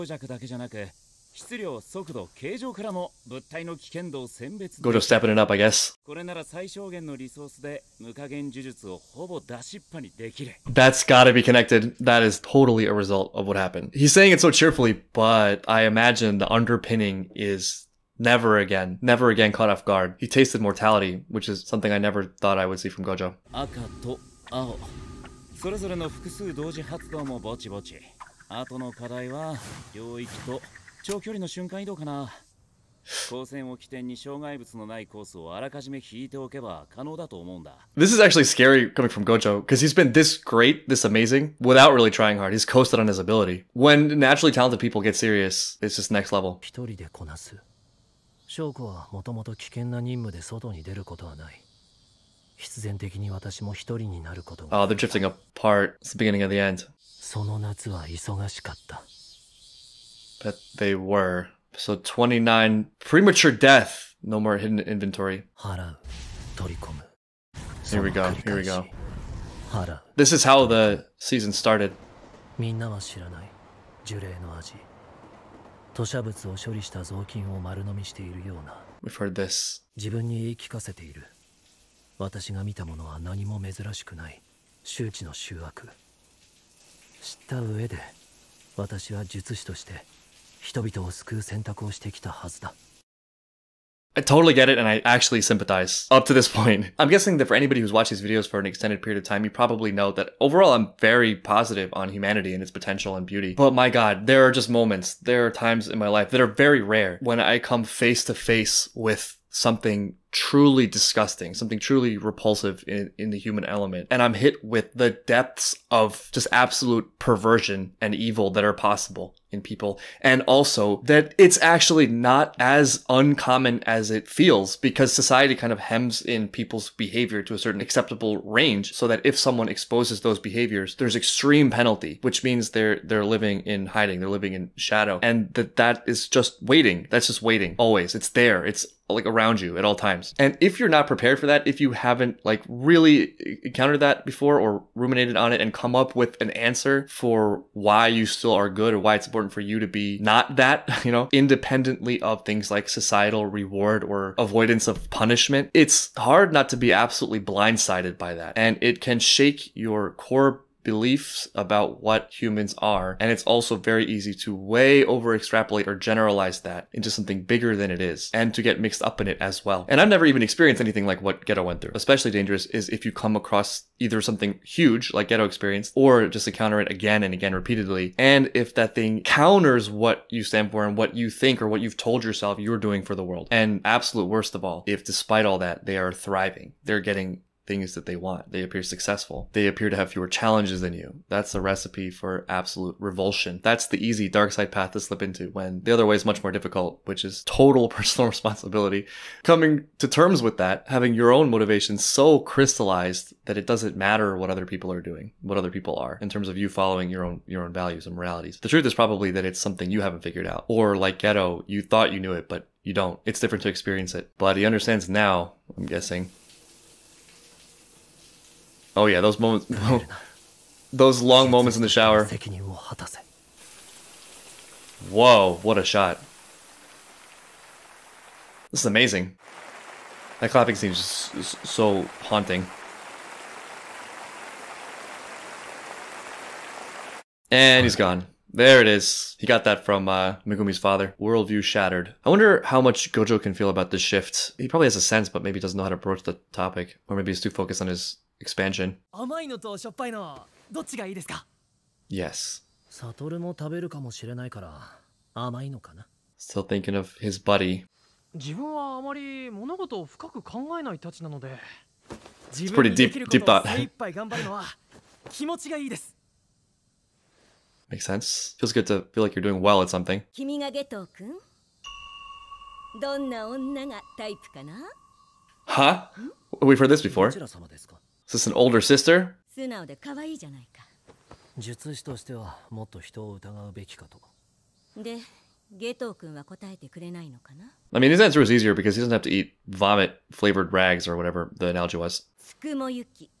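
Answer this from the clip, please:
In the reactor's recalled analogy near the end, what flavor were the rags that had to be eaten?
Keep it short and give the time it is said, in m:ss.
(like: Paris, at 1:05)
vomit, at 4:49.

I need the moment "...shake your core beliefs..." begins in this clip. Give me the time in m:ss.
2:39.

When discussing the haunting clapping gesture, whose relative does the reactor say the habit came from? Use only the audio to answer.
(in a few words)
Megumi's father.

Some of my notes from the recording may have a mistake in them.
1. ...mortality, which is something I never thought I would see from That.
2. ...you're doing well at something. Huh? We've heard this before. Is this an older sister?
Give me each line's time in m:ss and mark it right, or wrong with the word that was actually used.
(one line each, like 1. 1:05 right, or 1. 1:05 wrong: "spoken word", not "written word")
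1. 0:20 wrong: "Gojo", not "That"
2. 4:29 right.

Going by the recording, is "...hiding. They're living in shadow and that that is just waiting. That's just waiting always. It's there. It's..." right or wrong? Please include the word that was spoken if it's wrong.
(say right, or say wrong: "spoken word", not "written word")
right.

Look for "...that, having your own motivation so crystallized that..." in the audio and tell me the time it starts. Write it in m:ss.
3:20.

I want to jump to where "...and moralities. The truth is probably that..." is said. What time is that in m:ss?
3:28.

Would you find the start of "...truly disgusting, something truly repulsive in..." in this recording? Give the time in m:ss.
1:50.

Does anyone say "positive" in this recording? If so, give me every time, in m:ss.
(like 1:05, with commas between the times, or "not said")
1:41.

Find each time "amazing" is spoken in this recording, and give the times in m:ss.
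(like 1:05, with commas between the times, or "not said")
0:41, 3:48.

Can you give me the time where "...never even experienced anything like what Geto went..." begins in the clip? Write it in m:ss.
2:50.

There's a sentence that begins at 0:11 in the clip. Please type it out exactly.
That is totally a result of what happened.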